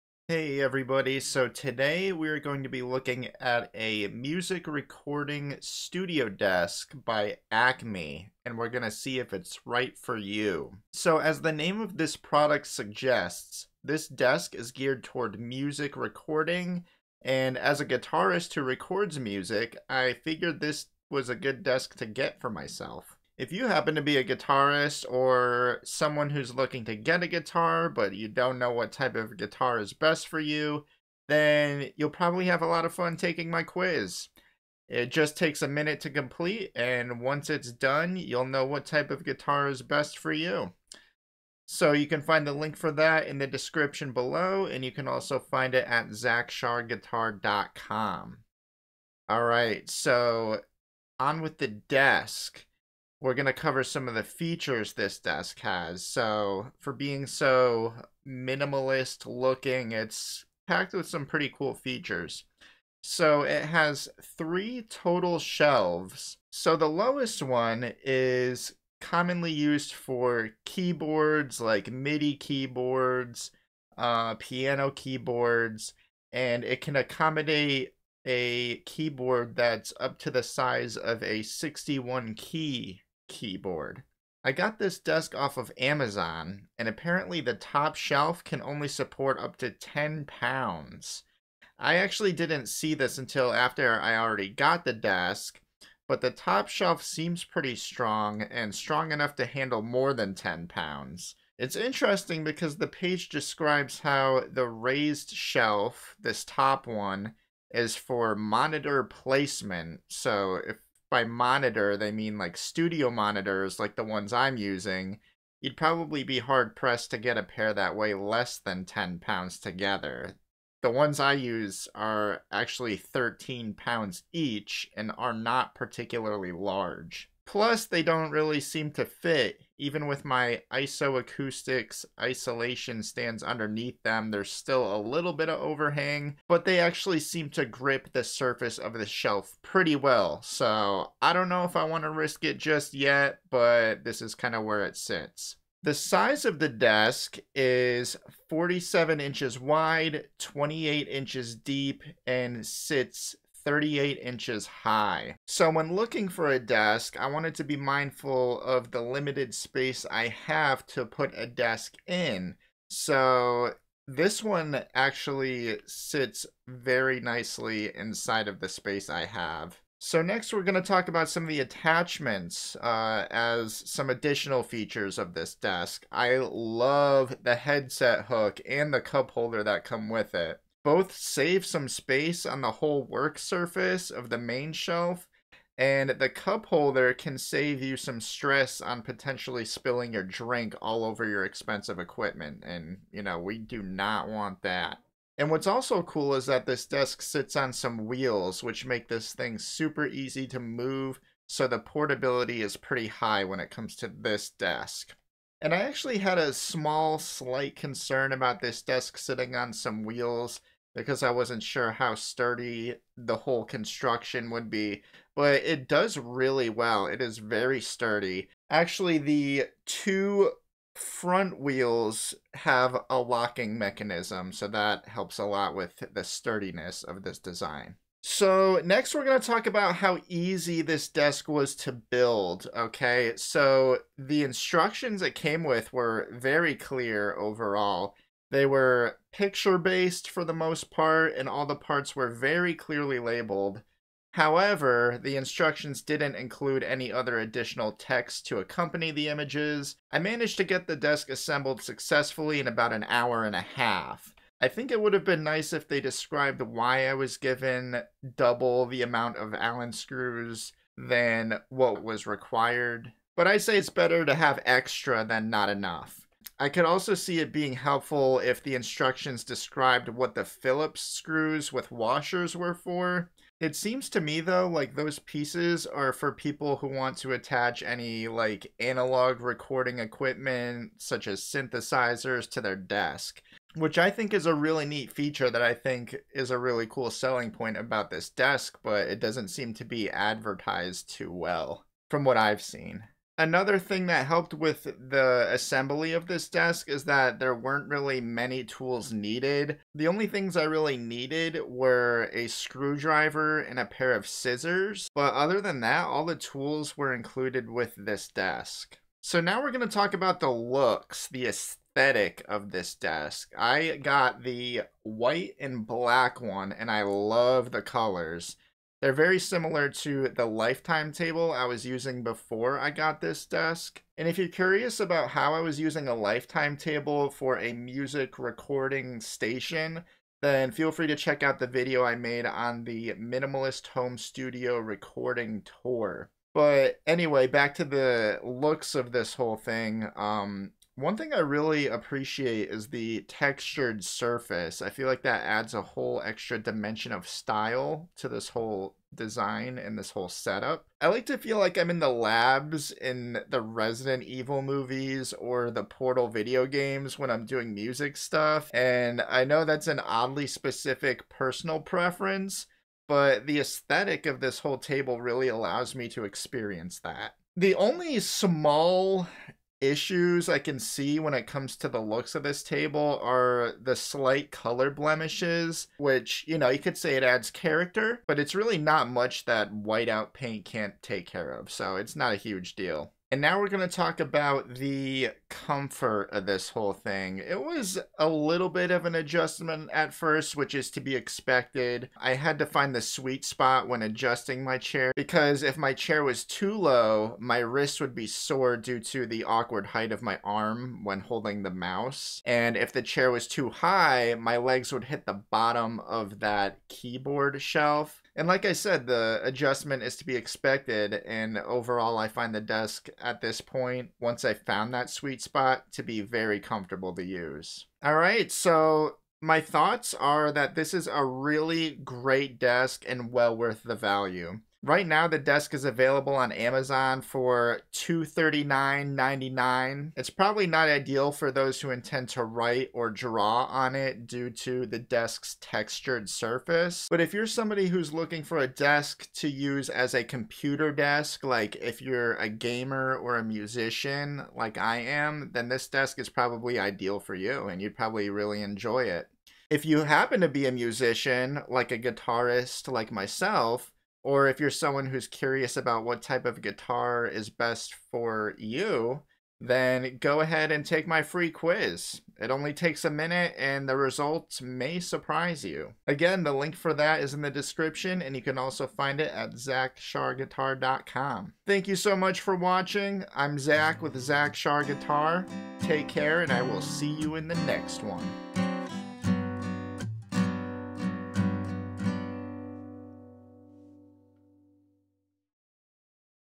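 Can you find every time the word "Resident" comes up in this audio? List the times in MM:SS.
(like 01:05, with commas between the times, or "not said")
05:53.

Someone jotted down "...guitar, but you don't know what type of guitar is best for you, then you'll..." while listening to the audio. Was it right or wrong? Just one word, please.
right.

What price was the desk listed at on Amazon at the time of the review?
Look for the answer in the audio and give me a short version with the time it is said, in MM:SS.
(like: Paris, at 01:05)
$239.99, at 07:07.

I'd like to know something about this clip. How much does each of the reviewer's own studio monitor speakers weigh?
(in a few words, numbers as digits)
13 pounds.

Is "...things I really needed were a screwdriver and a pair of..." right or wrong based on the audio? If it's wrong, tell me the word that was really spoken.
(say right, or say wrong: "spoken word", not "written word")
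right.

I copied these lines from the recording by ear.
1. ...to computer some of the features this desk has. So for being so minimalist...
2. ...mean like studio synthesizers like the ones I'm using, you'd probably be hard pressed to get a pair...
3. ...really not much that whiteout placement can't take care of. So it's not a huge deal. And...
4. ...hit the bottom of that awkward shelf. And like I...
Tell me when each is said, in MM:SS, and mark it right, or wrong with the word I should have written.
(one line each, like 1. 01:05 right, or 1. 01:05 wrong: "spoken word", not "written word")
1. 00:53 wrong: "cover", not "computer"
2. 01:52 wrong: "monitors", not "synthesizers"
3. 06:18 wrong: "paint", not "placement"
4. 06:45 wrong: "keyboard", not "awkward".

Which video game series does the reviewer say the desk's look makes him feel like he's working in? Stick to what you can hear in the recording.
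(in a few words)
Portal.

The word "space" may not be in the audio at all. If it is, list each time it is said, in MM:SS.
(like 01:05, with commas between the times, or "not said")
02:39, 02:48, 03:01.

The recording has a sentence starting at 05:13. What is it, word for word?
I got the white and black one, and I love the colors.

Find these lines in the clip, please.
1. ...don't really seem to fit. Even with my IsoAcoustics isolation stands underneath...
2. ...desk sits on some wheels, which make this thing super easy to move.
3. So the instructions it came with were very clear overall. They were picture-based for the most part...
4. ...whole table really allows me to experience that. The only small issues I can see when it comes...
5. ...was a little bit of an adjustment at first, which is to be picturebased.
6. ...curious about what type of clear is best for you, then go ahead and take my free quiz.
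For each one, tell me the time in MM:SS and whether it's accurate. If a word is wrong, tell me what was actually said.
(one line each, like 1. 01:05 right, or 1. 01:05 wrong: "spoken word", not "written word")
1. 02:08 right
2. 03:16 right
3. 03:53 right
4. 06:04 right
5. 06:27 wrong: "expected", not "picturebased"
6. 07:35 wrong: "guitar", not "clear".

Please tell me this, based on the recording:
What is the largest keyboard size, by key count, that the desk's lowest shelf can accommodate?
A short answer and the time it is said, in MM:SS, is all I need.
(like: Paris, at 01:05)
61 key, at 01:21.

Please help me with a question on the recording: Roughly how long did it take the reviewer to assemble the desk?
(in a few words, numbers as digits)
An hour and a half.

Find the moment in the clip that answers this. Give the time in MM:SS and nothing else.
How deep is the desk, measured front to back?
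02:30.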